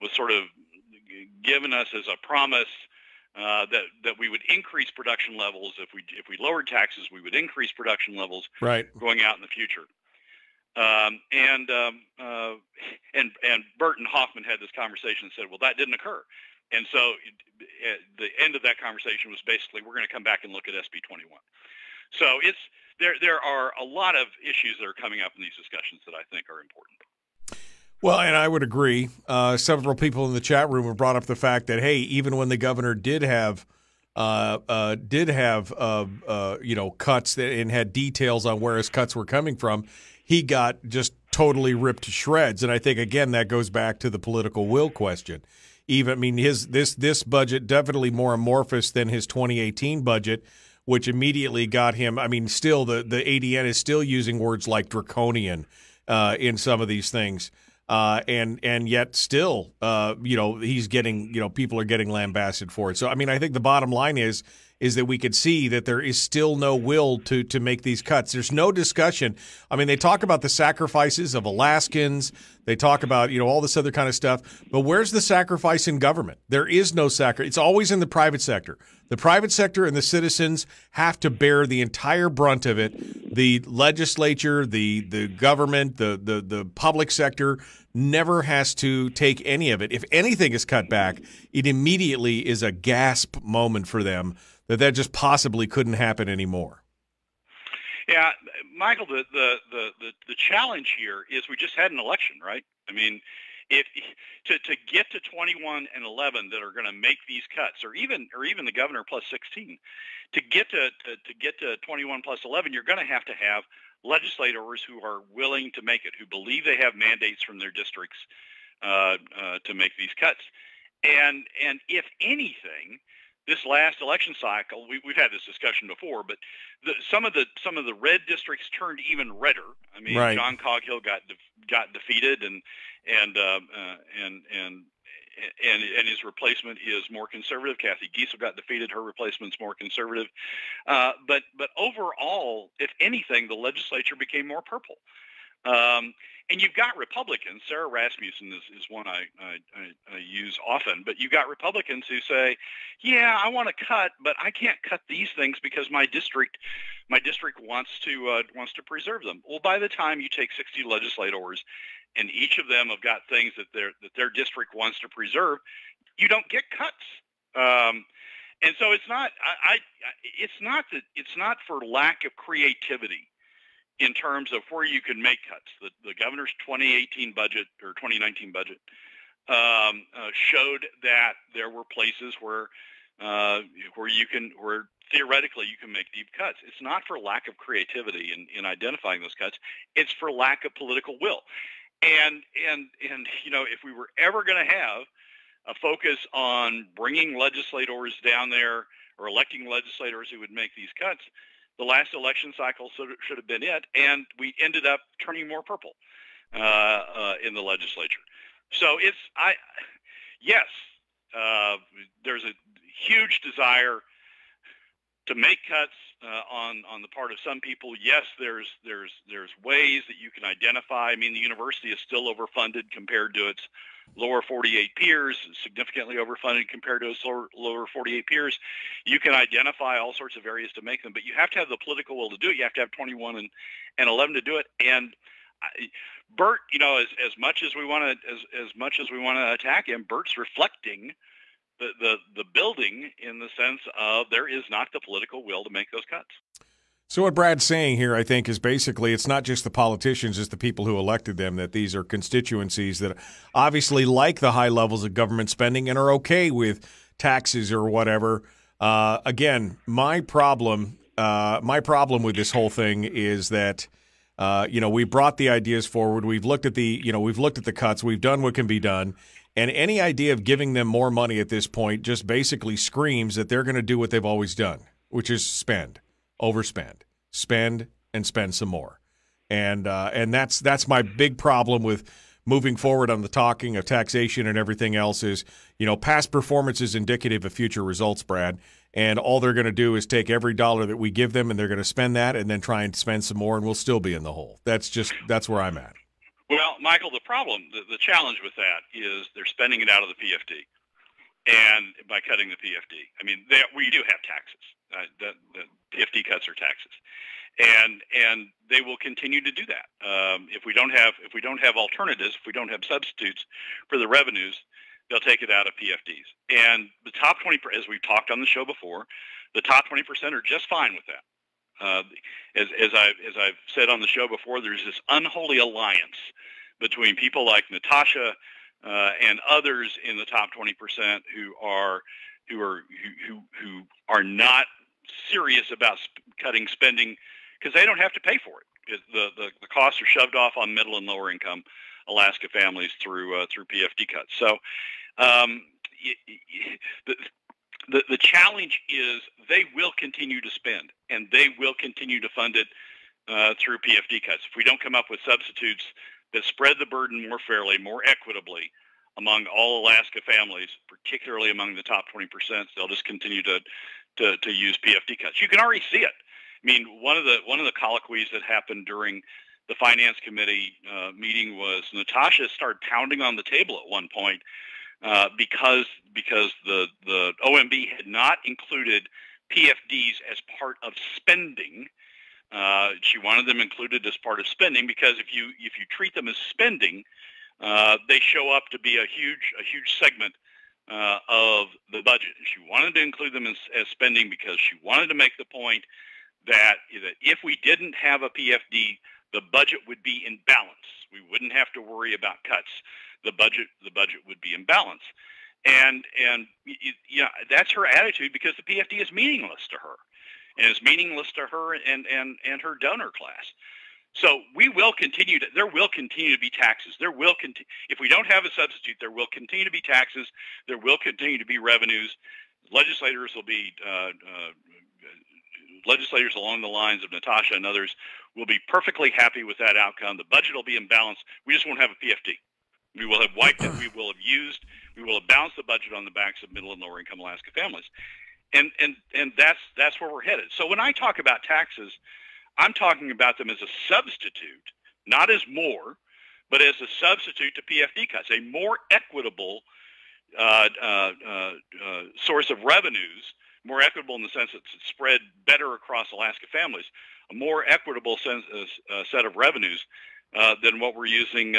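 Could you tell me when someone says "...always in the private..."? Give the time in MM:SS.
01:17.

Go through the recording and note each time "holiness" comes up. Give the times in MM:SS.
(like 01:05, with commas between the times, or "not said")
not said.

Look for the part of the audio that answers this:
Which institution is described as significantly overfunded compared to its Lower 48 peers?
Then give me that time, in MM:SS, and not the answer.
03:41.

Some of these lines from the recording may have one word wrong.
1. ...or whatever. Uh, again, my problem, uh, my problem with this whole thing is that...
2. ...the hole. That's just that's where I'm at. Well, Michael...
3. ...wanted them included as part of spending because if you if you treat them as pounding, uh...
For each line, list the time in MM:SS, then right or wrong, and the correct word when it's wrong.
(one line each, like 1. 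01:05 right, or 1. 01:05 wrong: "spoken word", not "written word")
1. 04:17 right
2. 04:54 right
3. 06:23 wrong: "spending", not "pounding".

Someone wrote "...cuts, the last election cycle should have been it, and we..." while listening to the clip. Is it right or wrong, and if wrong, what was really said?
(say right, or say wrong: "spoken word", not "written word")
right.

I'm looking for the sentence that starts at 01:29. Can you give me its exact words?
If anything is cut back, it immediately is a gasp moment for them that that just possibly couldn't happen anymore.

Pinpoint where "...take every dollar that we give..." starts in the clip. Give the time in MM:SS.
04:50.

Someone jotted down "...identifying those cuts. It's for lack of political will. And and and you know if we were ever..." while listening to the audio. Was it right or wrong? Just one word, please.
right.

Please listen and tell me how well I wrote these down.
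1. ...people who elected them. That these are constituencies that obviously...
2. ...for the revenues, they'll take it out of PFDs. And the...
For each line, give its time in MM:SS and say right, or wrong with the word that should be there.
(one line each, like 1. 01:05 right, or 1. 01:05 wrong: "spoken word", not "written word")
1. 04:10 right
2. 05:13 right.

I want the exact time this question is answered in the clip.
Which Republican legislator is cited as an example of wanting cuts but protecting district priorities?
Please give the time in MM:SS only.
02:27.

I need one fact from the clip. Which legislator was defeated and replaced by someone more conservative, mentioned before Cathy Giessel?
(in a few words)
John Coghill.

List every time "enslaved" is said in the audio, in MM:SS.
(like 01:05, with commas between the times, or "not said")
not said.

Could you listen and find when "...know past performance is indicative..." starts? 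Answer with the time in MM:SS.
04:45.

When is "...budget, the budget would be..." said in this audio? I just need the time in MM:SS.
06:43.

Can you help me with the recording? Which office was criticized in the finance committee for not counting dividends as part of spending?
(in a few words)
OMB.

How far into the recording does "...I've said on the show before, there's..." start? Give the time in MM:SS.
05:23.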